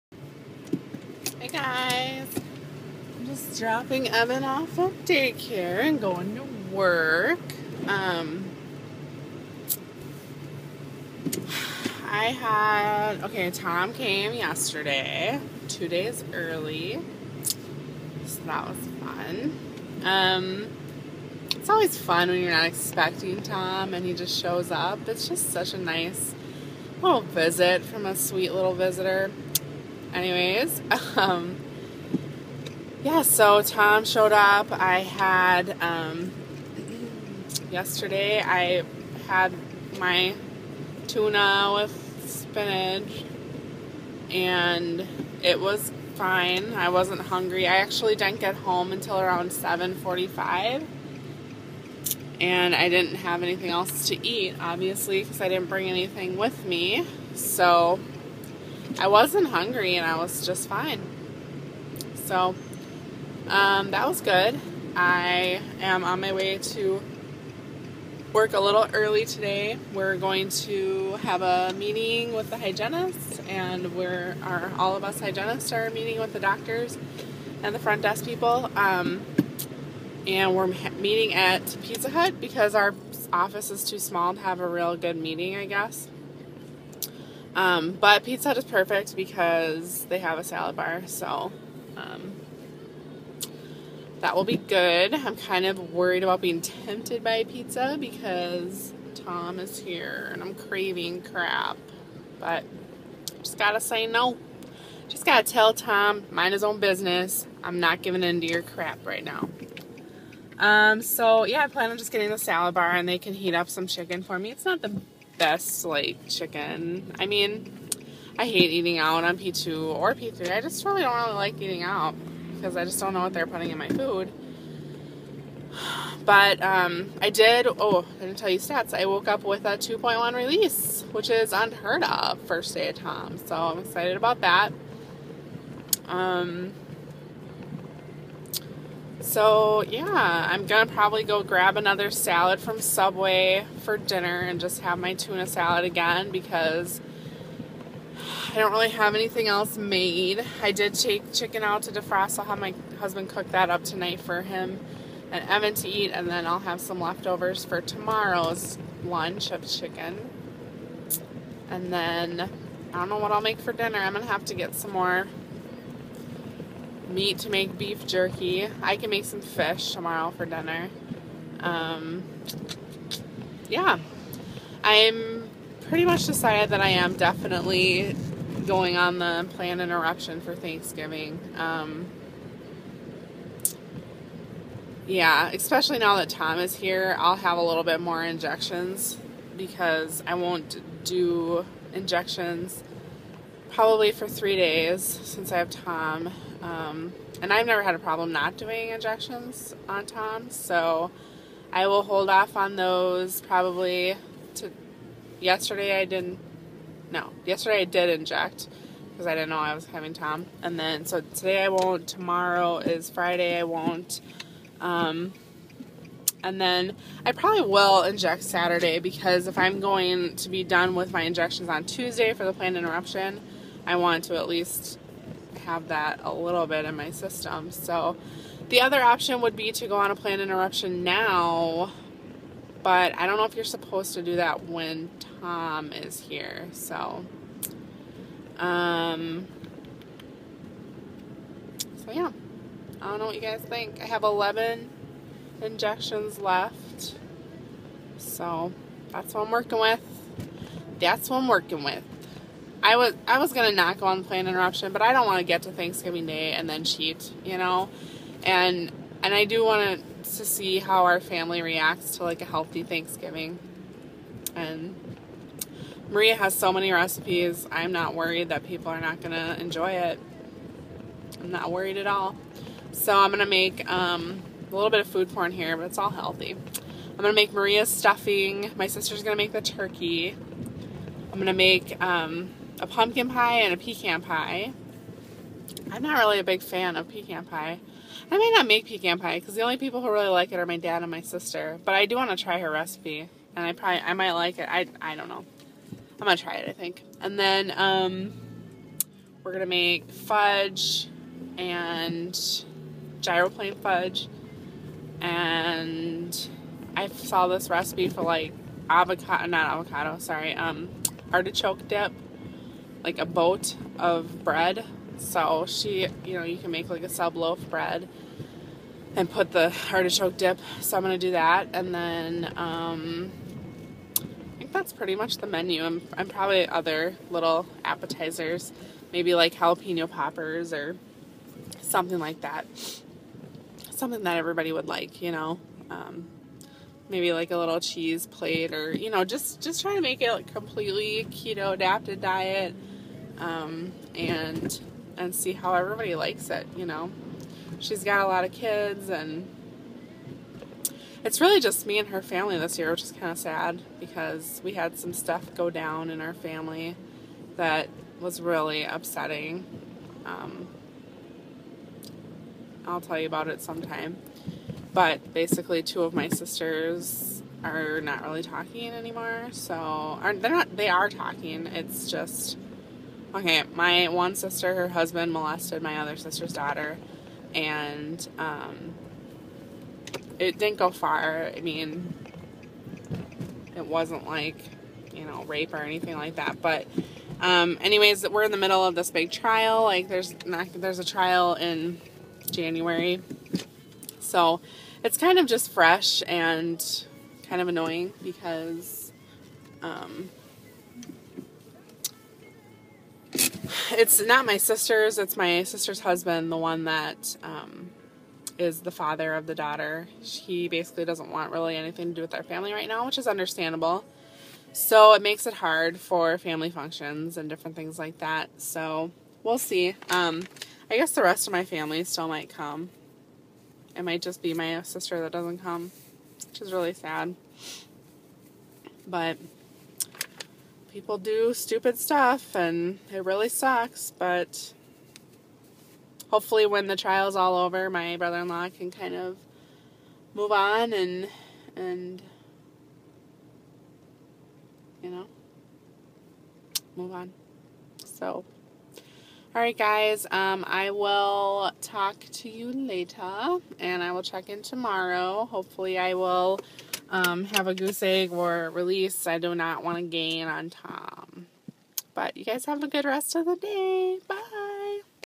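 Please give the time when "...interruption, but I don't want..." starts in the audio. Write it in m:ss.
4:14.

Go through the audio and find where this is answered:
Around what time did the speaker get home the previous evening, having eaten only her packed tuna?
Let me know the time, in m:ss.
0:49.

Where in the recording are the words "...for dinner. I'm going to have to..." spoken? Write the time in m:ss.
2:43.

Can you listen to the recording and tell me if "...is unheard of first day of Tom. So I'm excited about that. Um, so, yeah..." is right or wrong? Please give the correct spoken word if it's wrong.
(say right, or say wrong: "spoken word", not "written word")
right.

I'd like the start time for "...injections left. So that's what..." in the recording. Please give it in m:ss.
4:05.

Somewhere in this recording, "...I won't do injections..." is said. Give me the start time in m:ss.
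3:10.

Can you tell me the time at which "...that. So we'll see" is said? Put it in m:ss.
6:58.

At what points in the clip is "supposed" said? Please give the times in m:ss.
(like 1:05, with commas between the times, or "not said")
3:53.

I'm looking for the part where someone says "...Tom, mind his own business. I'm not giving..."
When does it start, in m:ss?
1:45.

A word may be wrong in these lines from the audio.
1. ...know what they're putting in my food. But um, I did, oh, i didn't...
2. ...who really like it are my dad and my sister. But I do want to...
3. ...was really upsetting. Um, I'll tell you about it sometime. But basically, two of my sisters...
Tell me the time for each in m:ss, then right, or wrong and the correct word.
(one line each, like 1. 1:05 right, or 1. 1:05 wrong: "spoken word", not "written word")
1. 2:03 right
2. 4:50 right
3. 5:58 right.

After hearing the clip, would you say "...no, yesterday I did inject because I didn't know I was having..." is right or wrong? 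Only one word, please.
right.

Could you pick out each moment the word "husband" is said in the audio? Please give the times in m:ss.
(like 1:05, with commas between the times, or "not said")
2:32, 6:14, 6:45.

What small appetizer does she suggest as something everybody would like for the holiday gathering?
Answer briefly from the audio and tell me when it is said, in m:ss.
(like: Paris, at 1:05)
Jalapeno poppers, at 5:29.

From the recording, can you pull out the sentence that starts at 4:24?
And Maria has so many recipes.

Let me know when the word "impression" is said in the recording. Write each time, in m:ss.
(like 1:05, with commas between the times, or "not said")
not said.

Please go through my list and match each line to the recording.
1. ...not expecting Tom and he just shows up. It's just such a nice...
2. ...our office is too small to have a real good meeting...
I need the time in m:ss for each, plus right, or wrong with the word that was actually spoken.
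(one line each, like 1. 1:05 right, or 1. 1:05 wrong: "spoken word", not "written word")
1. 0:22 right
2. 1:22 right.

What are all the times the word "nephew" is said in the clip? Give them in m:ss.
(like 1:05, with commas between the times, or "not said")
not said.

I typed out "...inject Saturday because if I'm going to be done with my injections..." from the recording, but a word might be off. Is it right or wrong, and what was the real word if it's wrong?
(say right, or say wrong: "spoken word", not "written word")
right.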